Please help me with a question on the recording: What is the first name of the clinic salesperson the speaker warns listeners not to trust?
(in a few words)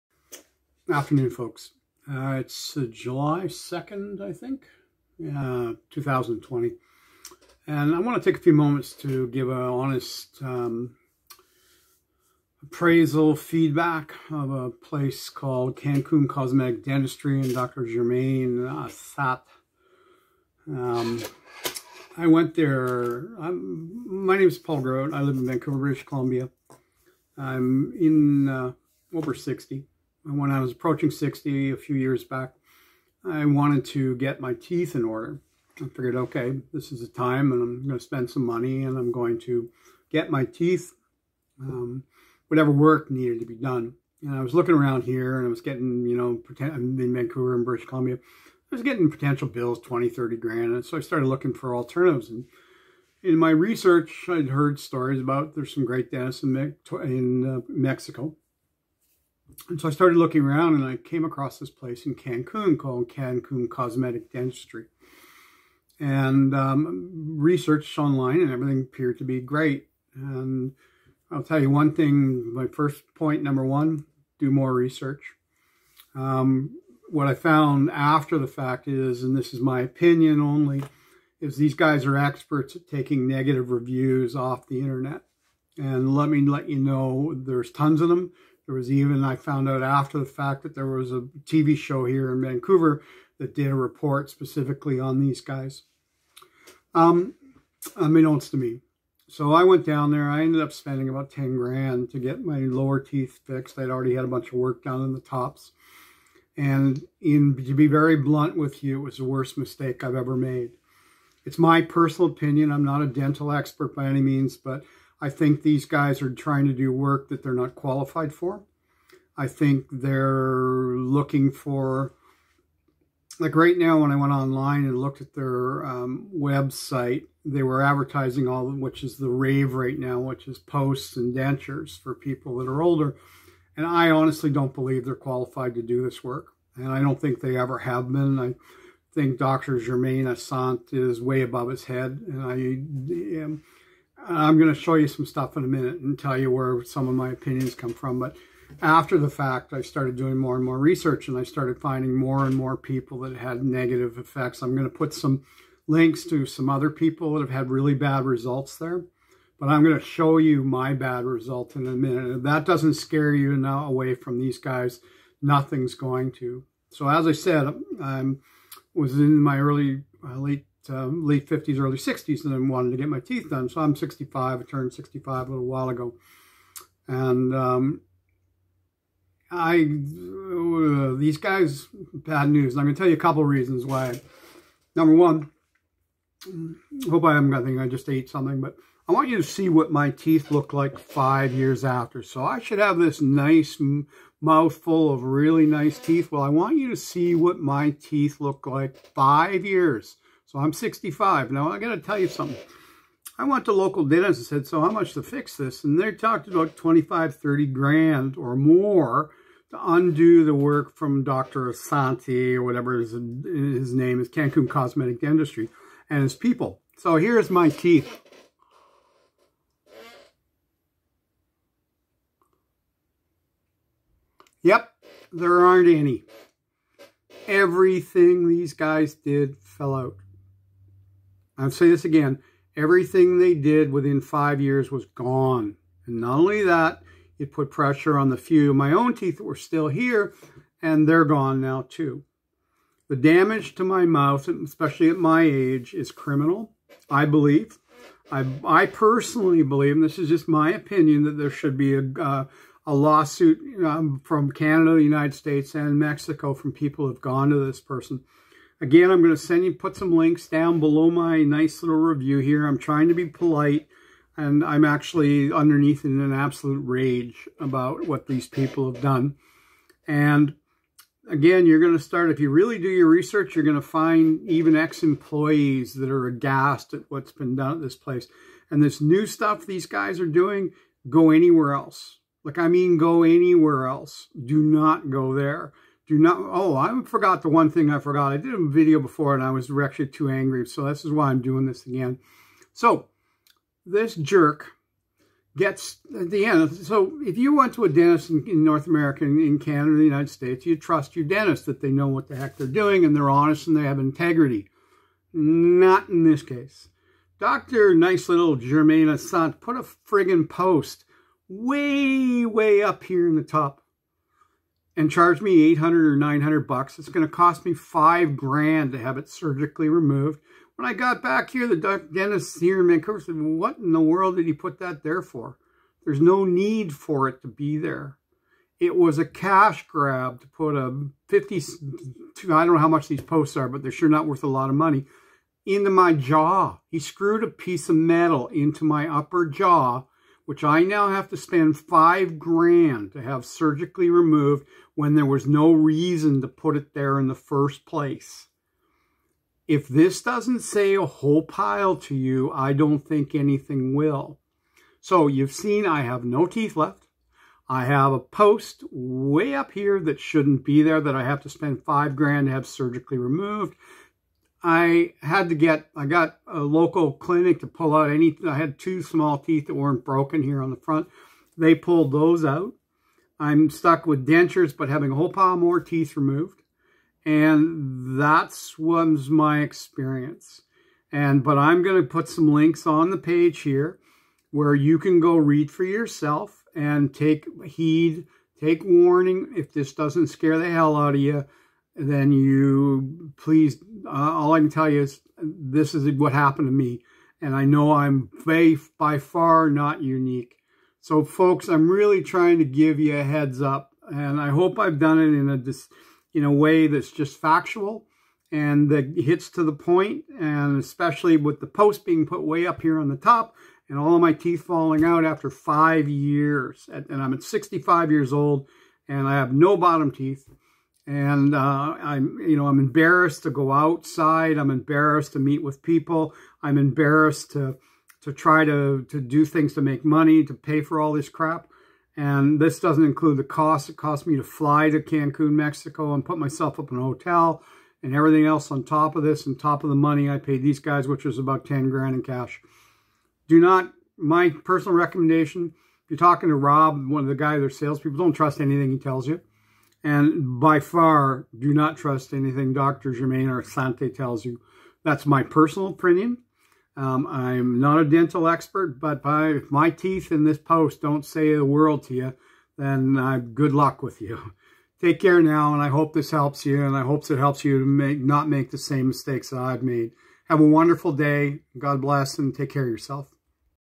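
Rob.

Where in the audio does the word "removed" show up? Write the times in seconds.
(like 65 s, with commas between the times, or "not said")
319 s, 344 s, 363 s, 376 s.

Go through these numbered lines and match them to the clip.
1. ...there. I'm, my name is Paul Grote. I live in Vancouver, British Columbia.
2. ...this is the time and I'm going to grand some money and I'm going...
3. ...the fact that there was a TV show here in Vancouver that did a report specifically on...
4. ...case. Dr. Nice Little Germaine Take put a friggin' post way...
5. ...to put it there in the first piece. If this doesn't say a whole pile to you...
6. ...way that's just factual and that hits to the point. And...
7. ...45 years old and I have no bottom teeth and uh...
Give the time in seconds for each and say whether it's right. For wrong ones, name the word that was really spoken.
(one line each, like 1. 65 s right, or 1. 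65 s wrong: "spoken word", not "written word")
1. 22 s right
2. 36 s wrong: "spend", not "grand"
3. 90 s right
4. 306 s wrong: "Arzate", not "Take"
5. 346 s wrong: "place", not "piece"
6. 406 s right
7. 417 s wrong: "65", not "45".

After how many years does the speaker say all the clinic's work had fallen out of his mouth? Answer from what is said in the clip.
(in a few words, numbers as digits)
5 years.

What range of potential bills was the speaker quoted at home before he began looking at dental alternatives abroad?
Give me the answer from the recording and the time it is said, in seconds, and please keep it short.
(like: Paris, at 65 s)
20 to 30 thousand, at 49 s.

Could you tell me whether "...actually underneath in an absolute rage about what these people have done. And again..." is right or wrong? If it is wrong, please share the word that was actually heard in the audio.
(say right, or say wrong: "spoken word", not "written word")
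right.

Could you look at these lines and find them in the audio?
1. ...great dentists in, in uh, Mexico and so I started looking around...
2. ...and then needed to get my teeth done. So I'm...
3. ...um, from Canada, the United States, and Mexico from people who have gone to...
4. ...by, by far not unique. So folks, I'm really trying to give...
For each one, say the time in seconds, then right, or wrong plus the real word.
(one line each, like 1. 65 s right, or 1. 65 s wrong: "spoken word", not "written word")
1. 55 s right
2. 172 s wrong: "wanted", not "needed"
3. 253 s right
4. 398 s right.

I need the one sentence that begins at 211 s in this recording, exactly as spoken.
Asante or whatever his, his name is, Cancun Cosmetic Dentistry, and his people.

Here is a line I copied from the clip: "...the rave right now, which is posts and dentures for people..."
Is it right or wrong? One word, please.
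right.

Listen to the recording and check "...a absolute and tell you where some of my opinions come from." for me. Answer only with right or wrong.
wrong.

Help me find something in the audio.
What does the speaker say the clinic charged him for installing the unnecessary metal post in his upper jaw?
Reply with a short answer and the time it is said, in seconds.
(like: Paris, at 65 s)
800 or 900 dollars, at 315 s.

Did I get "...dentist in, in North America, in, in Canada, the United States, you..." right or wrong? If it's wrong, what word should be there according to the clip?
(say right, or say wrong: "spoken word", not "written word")
right.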